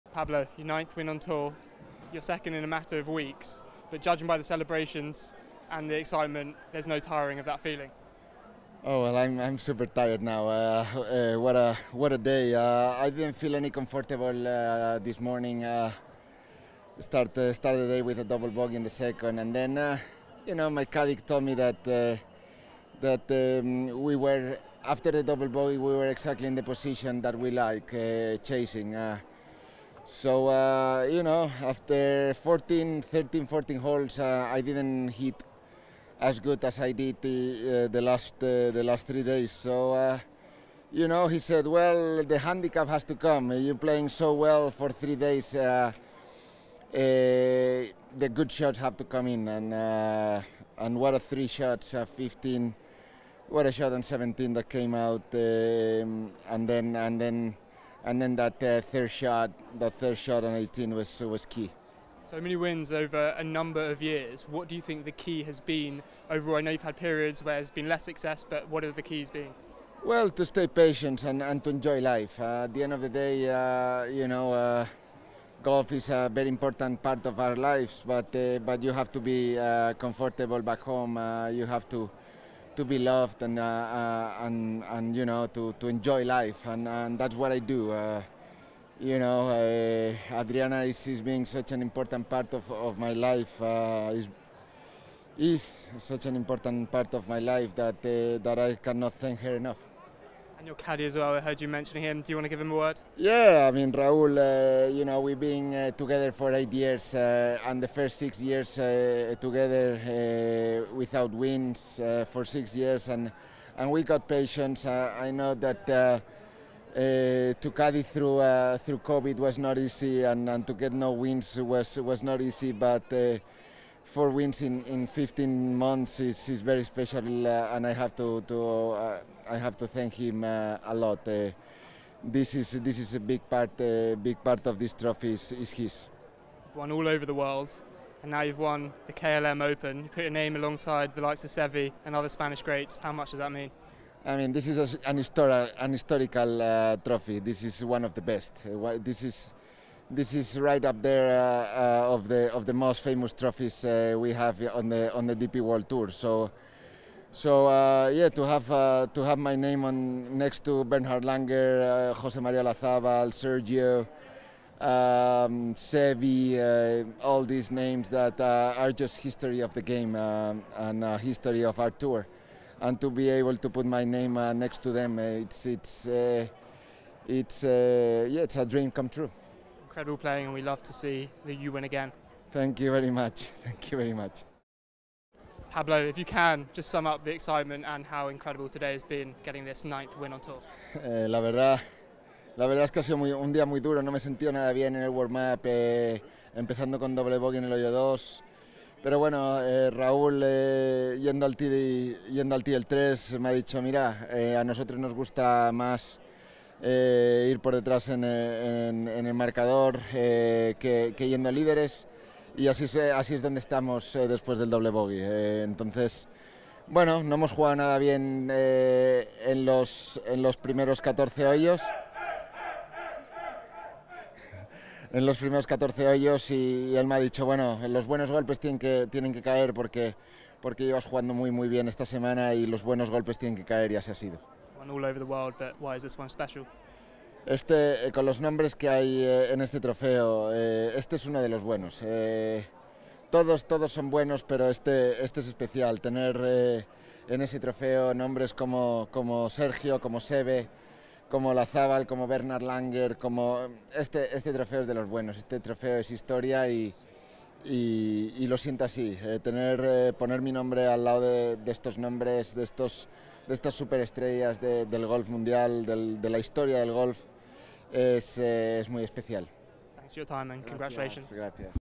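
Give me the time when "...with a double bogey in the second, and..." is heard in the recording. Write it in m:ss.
0:18.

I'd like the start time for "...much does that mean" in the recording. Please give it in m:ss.
2:23.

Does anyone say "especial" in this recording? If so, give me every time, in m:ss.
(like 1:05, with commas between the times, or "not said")
4:05, 4:29.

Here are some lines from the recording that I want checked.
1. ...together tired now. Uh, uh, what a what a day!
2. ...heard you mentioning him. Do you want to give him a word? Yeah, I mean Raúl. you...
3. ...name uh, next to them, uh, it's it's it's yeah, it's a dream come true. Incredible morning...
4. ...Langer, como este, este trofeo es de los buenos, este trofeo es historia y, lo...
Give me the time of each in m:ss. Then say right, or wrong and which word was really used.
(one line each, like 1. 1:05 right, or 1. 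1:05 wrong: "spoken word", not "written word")
1. 0:09 wrong: "super", not "together"
2. 1:41 right
3. 2:54 wrong: "playing", not "morning"
4. 4:12 right.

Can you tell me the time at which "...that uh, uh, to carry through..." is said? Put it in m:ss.
1:55.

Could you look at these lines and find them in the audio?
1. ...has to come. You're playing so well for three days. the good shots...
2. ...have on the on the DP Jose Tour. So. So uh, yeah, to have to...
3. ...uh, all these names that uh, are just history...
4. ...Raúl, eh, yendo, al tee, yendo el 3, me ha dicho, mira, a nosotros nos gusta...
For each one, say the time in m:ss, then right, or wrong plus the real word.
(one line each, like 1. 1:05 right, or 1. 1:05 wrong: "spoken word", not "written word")
1. 0:42 right
2. 2:34 wrong: "World", not "Jose"
3. 2:46 right
4. 3:19 right.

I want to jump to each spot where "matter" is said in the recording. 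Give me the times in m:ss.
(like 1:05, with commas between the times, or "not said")
0:02.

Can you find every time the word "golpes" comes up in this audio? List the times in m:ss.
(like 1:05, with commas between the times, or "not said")
3:48, 3:53.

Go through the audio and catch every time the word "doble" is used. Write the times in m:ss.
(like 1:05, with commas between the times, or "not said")
3:17, 3:34.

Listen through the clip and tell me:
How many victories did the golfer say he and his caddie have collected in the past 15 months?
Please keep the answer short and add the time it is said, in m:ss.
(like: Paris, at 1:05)
4, at 2:04.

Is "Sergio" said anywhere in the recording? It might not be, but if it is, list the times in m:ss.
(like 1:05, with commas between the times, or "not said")
2:43, 4:09.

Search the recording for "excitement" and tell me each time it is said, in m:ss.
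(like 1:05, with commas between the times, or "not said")
0:05, 3:07.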